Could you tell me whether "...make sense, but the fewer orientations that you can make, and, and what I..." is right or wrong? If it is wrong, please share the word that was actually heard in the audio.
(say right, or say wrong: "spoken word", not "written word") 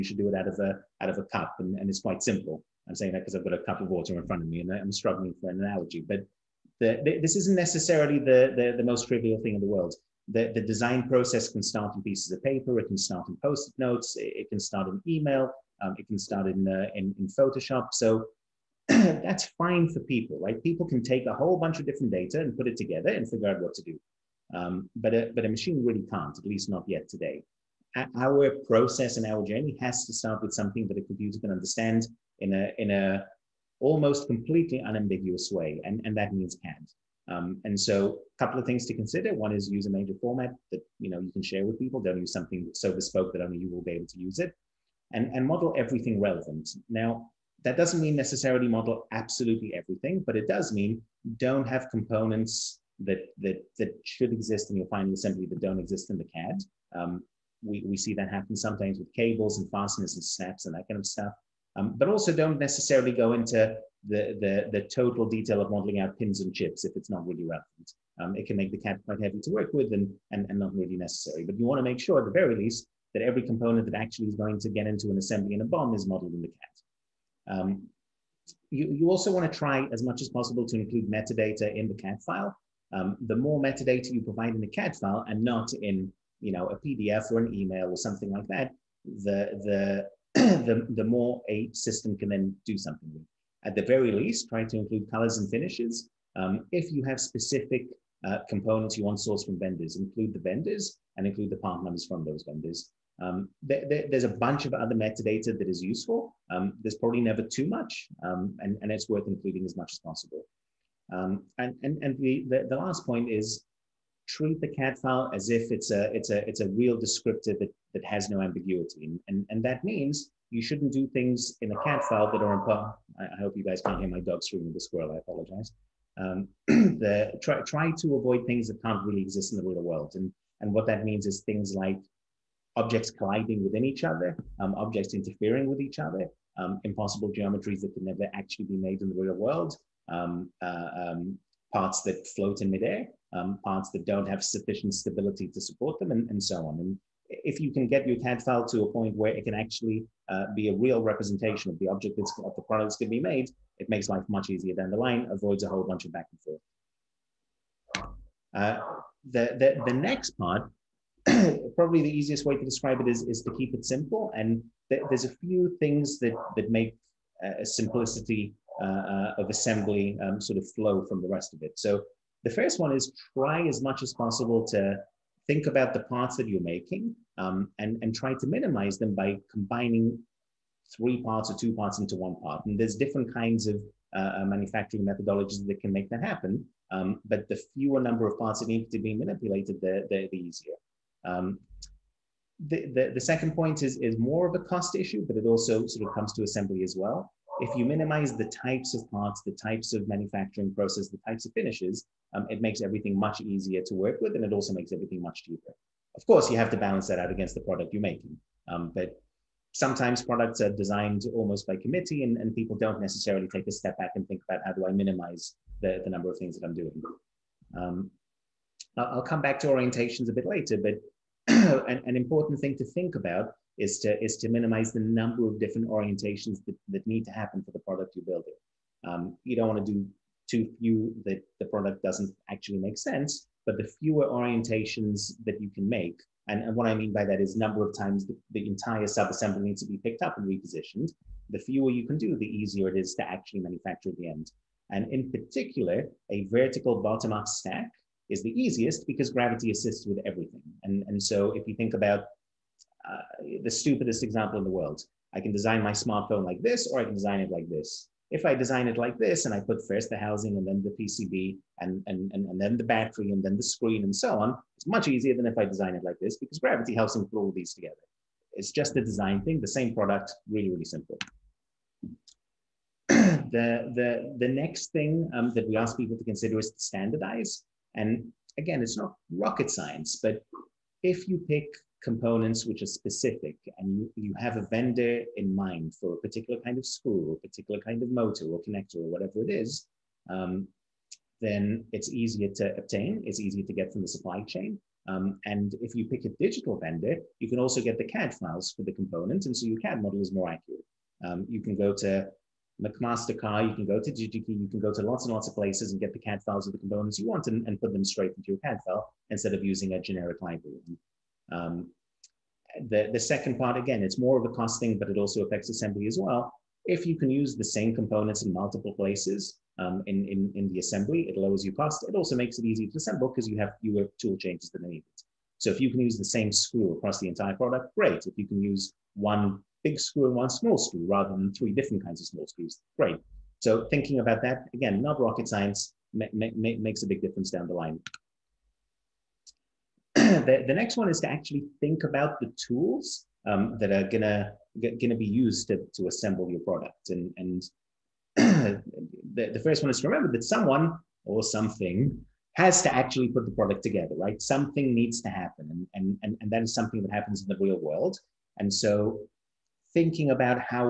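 right.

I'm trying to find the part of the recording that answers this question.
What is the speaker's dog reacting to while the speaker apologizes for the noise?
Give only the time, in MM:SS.
02:04.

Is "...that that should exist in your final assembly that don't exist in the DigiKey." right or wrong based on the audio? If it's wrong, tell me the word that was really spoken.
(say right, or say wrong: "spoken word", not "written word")
wrong: "CAD", not "DigiKey".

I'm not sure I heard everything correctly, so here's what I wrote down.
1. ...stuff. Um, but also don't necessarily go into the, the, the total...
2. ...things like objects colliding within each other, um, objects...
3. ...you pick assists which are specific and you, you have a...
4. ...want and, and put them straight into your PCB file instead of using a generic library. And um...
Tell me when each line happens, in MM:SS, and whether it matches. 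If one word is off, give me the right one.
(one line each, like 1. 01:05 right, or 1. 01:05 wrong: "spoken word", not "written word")
1. 01:01 right
2. 02:11 right
3. 04:41 wrong: "components", not "assists"
4. 05:07 wrong: "CAD", not "PCB".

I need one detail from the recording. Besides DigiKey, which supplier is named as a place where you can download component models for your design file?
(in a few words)
McMaster-Carr.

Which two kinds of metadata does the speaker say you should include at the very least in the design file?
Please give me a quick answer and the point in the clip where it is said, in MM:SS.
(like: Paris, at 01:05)
colors and finishes, at 01:35.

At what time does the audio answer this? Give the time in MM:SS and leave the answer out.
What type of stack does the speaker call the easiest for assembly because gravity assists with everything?
04:06.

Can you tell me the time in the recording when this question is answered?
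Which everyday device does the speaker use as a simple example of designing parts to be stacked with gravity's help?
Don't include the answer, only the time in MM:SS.
04:15.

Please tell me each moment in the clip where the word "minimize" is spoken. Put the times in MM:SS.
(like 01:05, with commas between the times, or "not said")
02:58, 03:17, 03:34, 03:44.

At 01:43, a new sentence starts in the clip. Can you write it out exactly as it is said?
Um, there's a bunch of other metadata that is useful.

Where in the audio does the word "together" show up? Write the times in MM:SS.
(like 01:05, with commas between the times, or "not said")
00:22, 04:27, 05:53.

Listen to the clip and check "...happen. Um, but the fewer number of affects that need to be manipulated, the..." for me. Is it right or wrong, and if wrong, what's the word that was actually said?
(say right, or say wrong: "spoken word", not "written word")
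wrong: "parts", not "affects".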